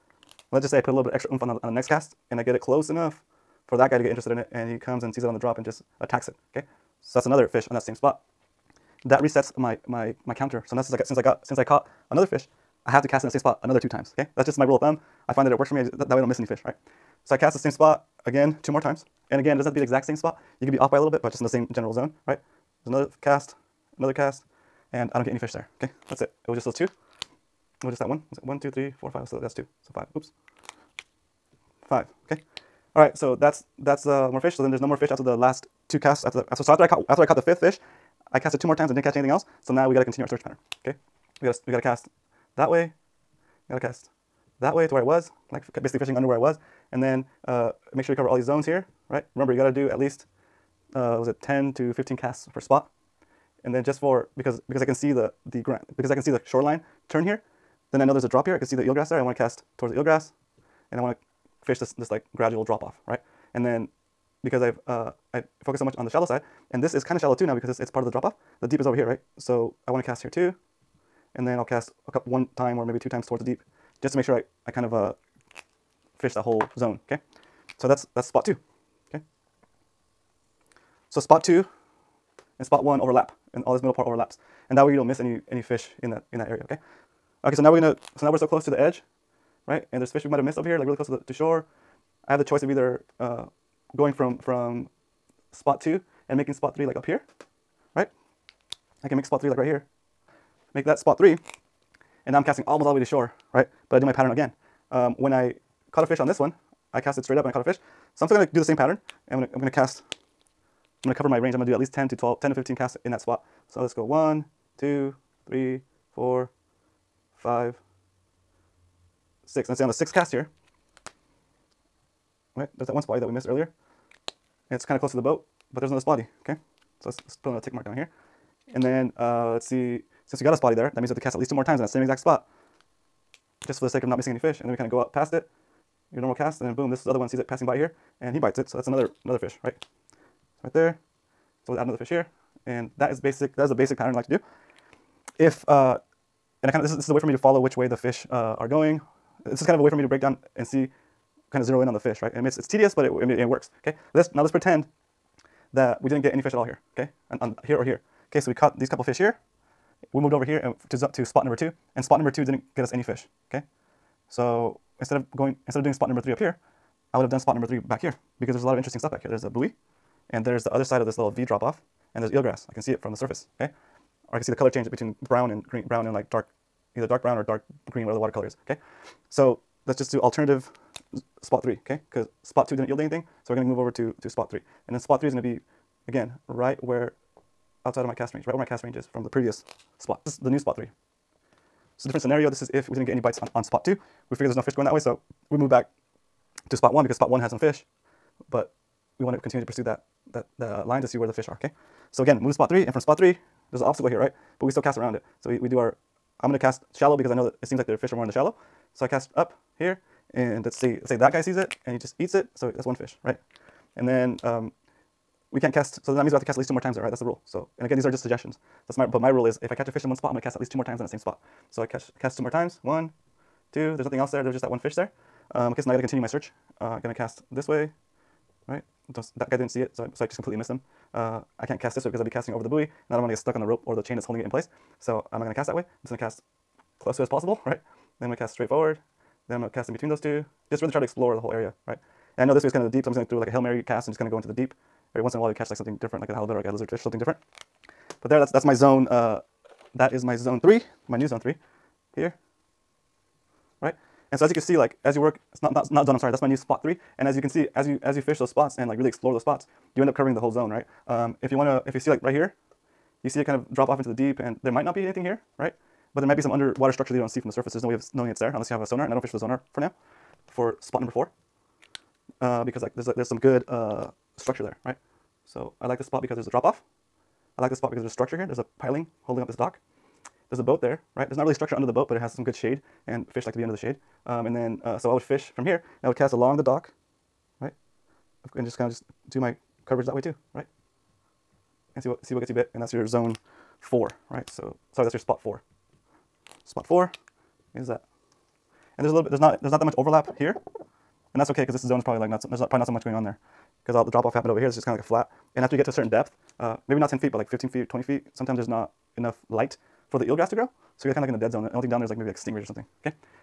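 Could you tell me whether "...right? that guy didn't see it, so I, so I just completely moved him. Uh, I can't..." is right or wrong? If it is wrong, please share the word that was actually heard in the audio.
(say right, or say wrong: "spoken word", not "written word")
wrong: "missed", not "moved".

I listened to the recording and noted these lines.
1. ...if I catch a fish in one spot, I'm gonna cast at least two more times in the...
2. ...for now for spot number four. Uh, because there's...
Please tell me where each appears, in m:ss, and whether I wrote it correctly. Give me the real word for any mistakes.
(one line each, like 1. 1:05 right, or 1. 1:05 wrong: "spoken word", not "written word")
1. 3:39 right
2. 4:29 right.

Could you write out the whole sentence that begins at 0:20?
You could be off by a little bit, but just in the same general zone, right?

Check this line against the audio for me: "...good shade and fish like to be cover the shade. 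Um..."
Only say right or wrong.
wrong.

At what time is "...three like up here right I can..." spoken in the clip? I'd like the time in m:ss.
1:36.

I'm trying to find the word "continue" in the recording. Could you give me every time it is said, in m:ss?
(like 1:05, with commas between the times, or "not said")
0:40, 3:19, 3:46.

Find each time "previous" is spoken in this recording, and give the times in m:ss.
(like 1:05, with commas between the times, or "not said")
3:09.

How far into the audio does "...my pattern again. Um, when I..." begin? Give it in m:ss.
1:44.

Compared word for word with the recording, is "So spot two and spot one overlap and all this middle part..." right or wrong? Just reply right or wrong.
right.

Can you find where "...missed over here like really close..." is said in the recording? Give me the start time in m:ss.
1:30.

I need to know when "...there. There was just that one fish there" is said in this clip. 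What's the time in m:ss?
3:44.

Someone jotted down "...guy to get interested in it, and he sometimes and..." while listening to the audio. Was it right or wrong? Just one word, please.
wrong.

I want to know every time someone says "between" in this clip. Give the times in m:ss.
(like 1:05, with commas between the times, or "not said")
2:54, 3:59.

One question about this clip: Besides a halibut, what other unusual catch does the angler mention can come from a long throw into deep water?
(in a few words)
Lizard fish.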